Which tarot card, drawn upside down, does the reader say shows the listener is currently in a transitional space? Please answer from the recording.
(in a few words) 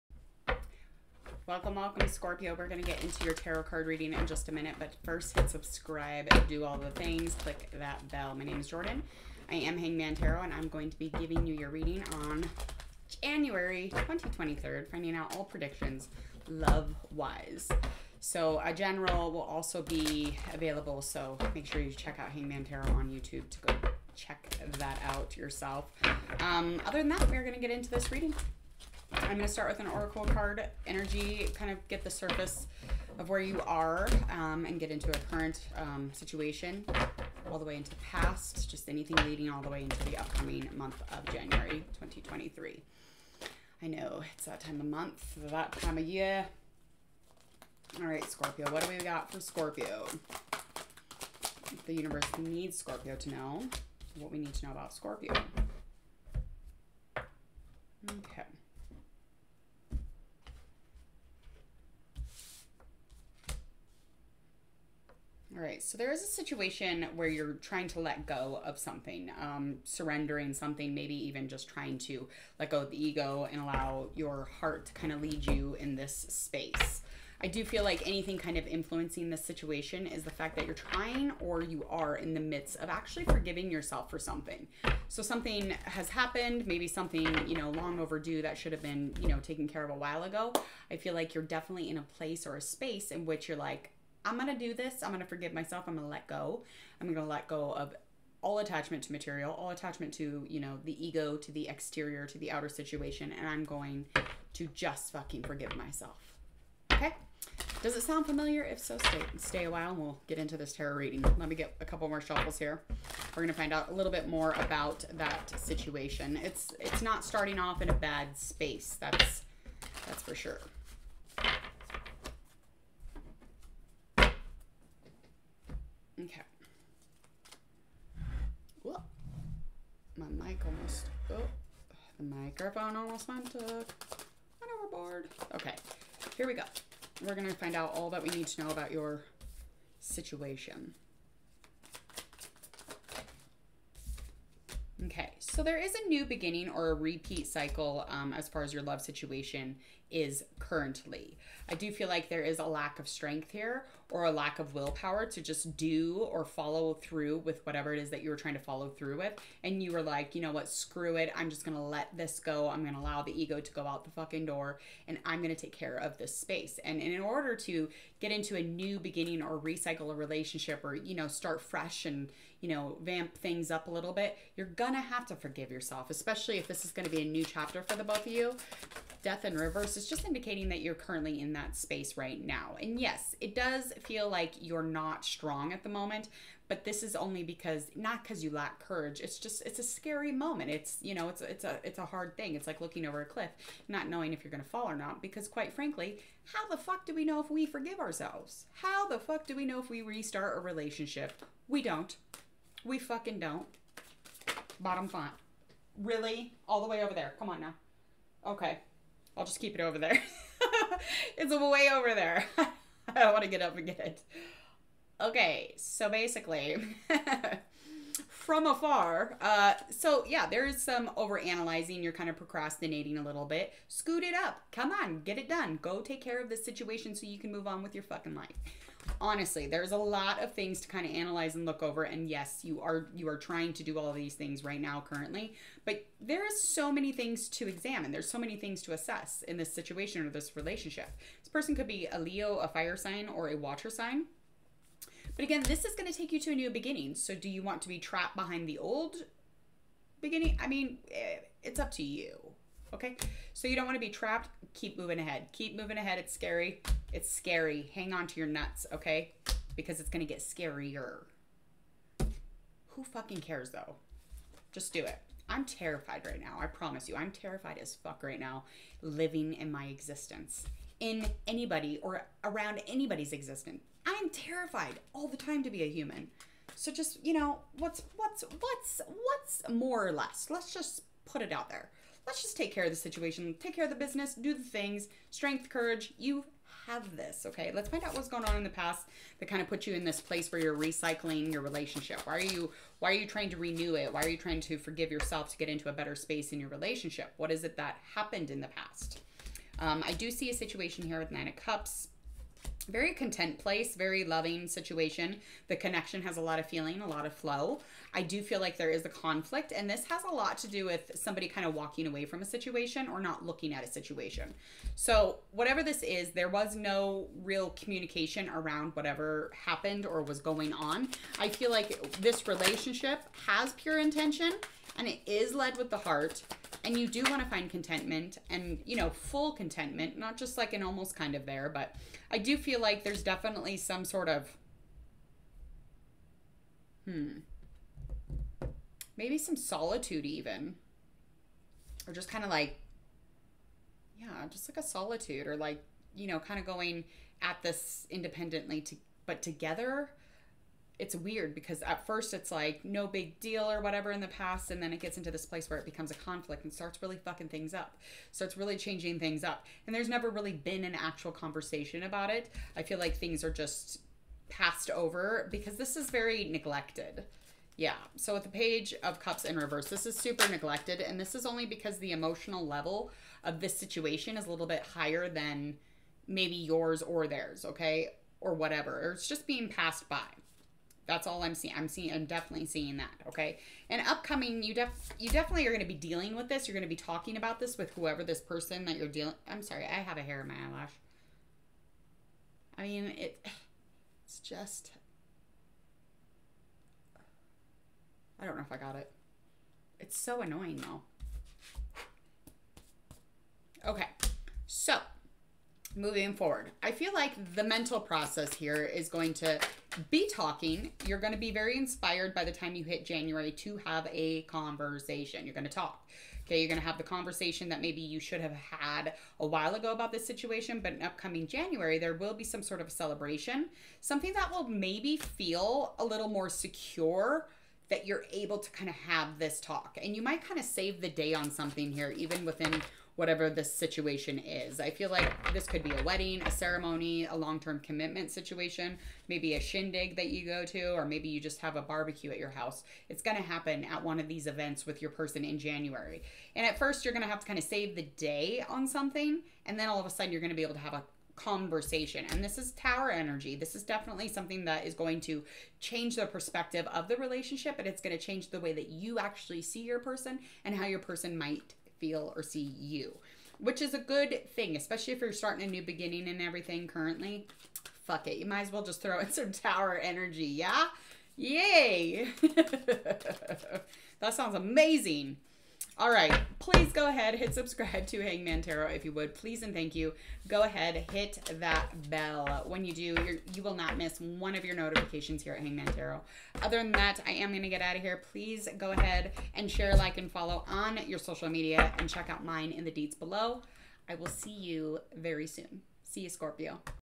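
Death.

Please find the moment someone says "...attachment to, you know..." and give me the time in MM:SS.
01:39.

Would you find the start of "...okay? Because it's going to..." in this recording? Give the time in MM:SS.
04:18.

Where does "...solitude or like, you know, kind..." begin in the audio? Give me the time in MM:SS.
05:44.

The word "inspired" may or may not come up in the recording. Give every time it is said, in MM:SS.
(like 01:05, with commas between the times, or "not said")
06:51.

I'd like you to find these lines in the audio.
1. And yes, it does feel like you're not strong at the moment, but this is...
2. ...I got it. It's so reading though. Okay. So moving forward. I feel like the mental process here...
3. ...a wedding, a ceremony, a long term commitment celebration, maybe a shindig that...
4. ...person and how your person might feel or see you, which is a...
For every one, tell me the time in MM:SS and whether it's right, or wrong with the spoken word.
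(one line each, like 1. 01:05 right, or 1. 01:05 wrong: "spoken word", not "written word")
1. 03:02 right
2. 06:38 wrong: "annoying", not "reading"
3. 07:15 wrong: "situation", not "celebration"
4. 07:39 right.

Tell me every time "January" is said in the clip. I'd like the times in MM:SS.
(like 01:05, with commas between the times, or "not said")
00:13, 00:41, 06:53, 07:01, 07:25.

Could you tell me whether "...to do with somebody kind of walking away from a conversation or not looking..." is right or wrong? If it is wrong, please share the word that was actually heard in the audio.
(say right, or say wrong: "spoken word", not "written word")
wrong: "situation", not "conversation".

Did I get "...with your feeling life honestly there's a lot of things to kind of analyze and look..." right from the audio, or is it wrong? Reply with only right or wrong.
wrong.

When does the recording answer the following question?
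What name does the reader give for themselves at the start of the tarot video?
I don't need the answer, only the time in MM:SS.
00:08.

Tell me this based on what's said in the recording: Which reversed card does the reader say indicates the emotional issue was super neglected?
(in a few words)
Page of Cups.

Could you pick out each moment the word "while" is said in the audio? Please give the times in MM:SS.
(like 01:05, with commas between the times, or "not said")
01:29, 01:49, 06:59.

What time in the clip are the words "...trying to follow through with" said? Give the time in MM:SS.
02:38.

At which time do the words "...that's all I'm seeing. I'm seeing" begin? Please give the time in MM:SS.
06:21.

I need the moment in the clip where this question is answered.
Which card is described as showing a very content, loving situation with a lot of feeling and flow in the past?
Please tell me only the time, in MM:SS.
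05:01.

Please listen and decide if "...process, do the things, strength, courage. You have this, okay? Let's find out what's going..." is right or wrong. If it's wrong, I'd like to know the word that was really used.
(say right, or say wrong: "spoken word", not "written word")
wrong: "business", not "process".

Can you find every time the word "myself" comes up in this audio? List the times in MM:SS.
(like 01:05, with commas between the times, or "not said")
01:35, 01:45.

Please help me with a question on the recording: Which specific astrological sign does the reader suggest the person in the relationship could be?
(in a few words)
Leo.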